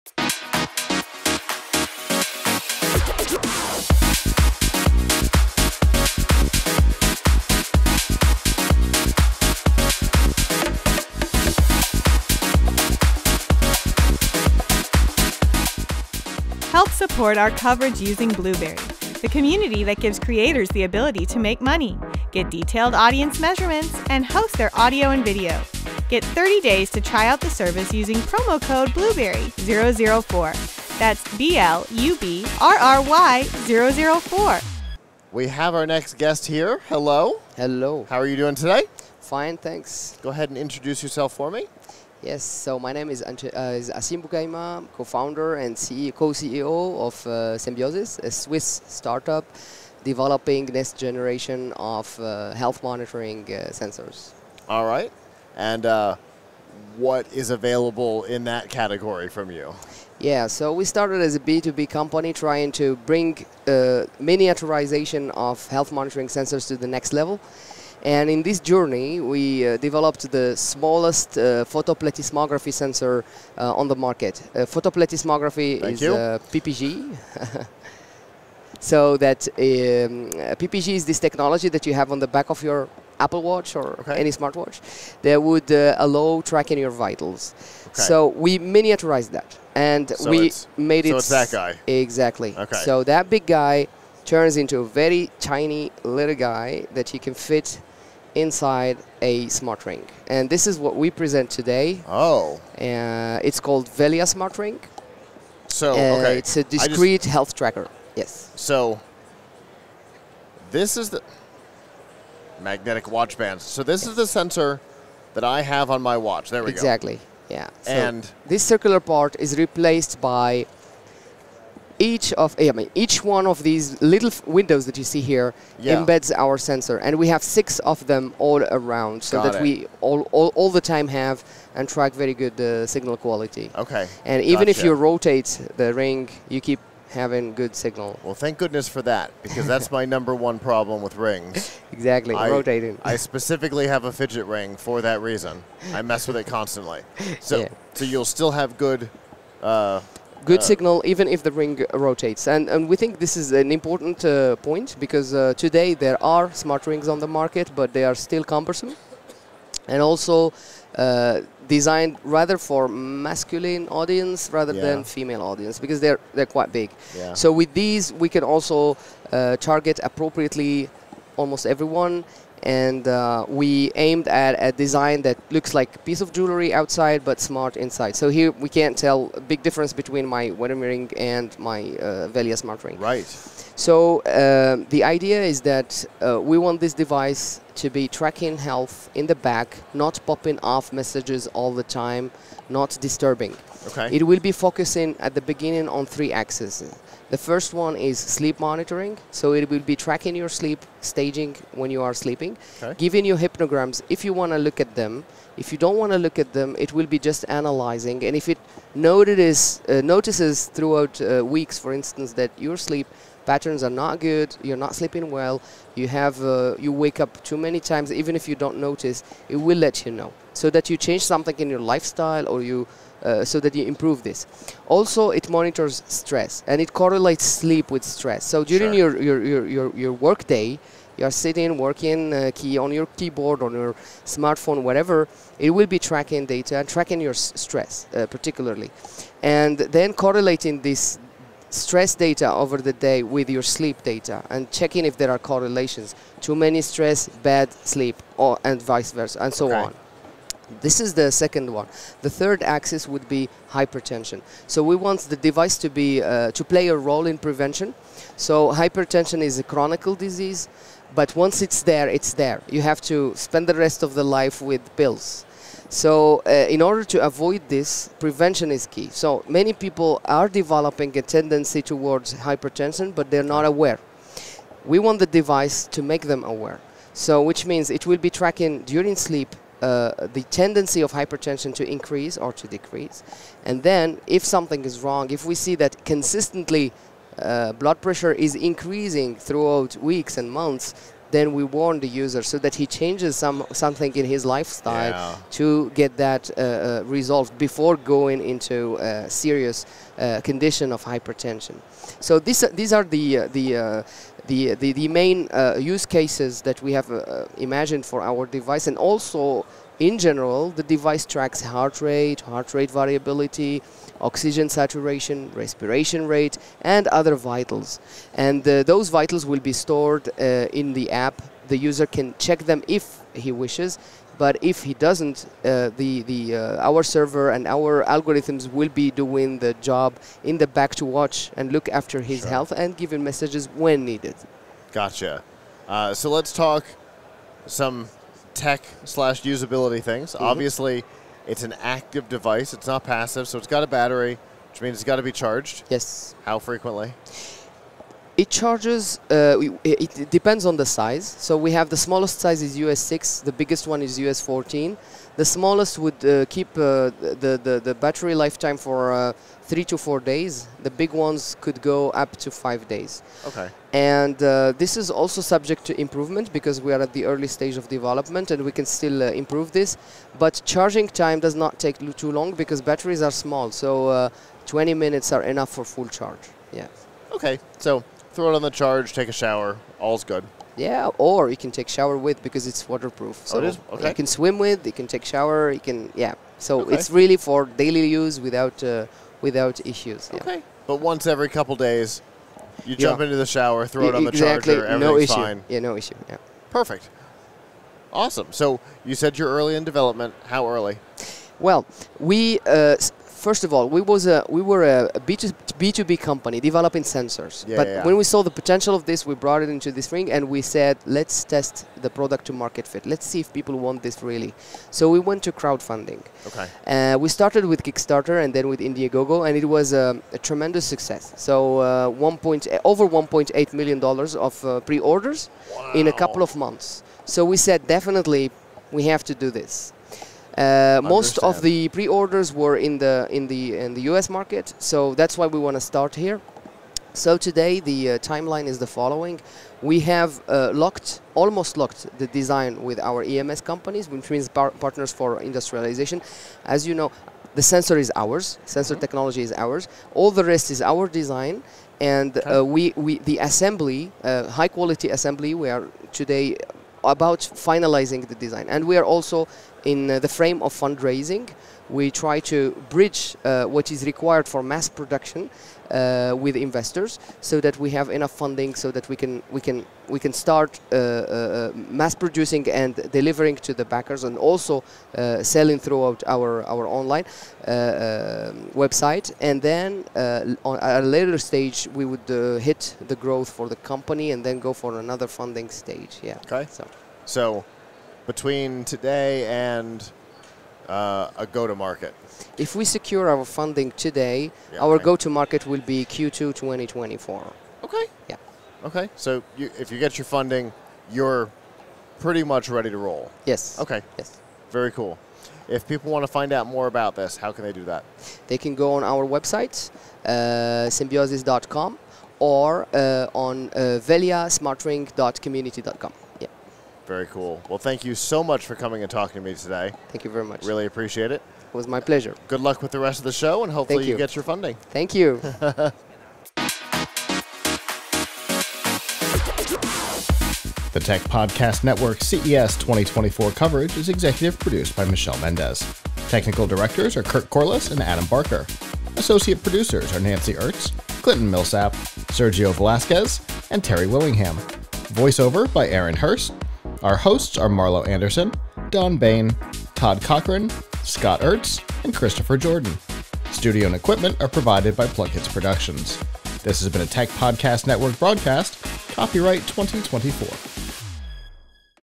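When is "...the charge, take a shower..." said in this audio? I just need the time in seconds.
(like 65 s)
378 s.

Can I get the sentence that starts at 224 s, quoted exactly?
Also, it monitors stress and it correlates sleep with stress.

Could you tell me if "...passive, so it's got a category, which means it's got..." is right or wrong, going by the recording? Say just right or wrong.
wrong.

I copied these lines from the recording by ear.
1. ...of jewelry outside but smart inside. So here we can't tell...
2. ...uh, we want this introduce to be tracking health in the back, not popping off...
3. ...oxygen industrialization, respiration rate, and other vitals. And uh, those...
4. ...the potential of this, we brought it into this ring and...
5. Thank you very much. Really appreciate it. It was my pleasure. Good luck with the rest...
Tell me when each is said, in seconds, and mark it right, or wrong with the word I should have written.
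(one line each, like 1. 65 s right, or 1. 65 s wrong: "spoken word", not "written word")
1. 176 s right
2. 186 s wrong: "device", not "introduce"
3. 314 s wrong: "saturation", not "industrialization"
4. 408 s right
5. 520 s right.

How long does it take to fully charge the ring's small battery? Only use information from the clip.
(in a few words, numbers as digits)
20 minutes.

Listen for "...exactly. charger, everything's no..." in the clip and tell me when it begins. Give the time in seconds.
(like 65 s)
394 s.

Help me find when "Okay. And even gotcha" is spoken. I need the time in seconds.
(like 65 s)
133 s.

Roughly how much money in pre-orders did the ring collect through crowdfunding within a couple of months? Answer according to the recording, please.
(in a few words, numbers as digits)
1.8 million dollars.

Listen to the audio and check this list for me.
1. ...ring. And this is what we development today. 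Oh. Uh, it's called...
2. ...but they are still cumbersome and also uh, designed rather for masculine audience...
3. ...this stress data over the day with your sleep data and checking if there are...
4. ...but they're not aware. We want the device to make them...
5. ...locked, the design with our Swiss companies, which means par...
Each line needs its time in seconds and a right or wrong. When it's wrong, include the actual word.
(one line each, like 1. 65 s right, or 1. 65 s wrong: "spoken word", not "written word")
1. 99 s wrong: "present", not "development"
2. 157 s right
3. 240 s right
4. 273 s right
5. 441 s wrong: "EMS", not "Swiss".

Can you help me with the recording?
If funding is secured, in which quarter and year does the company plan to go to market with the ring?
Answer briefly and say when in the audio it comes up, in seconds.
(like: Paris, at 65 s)
Q2 2024, at 496 s.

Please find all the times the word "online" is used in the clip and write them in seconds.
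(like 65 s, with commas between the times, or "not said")
476 s.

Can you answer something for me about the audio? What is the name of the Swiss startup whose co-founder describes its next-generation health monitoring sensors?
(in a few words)
Senbiosys.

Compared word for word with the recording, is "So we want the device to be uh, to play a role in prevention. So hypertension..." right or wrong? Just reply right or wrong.
right.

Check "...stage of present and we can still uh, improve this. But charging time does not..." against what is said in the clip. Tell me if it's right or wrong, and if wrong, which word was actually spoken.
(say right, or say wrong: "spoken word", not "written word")
wrong: "development", not "present".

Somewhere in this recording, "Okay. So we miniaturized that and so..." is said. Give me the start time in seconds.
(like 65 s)
87 s.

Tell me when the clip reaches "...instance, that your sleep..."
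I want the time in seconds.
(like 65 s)
211 s.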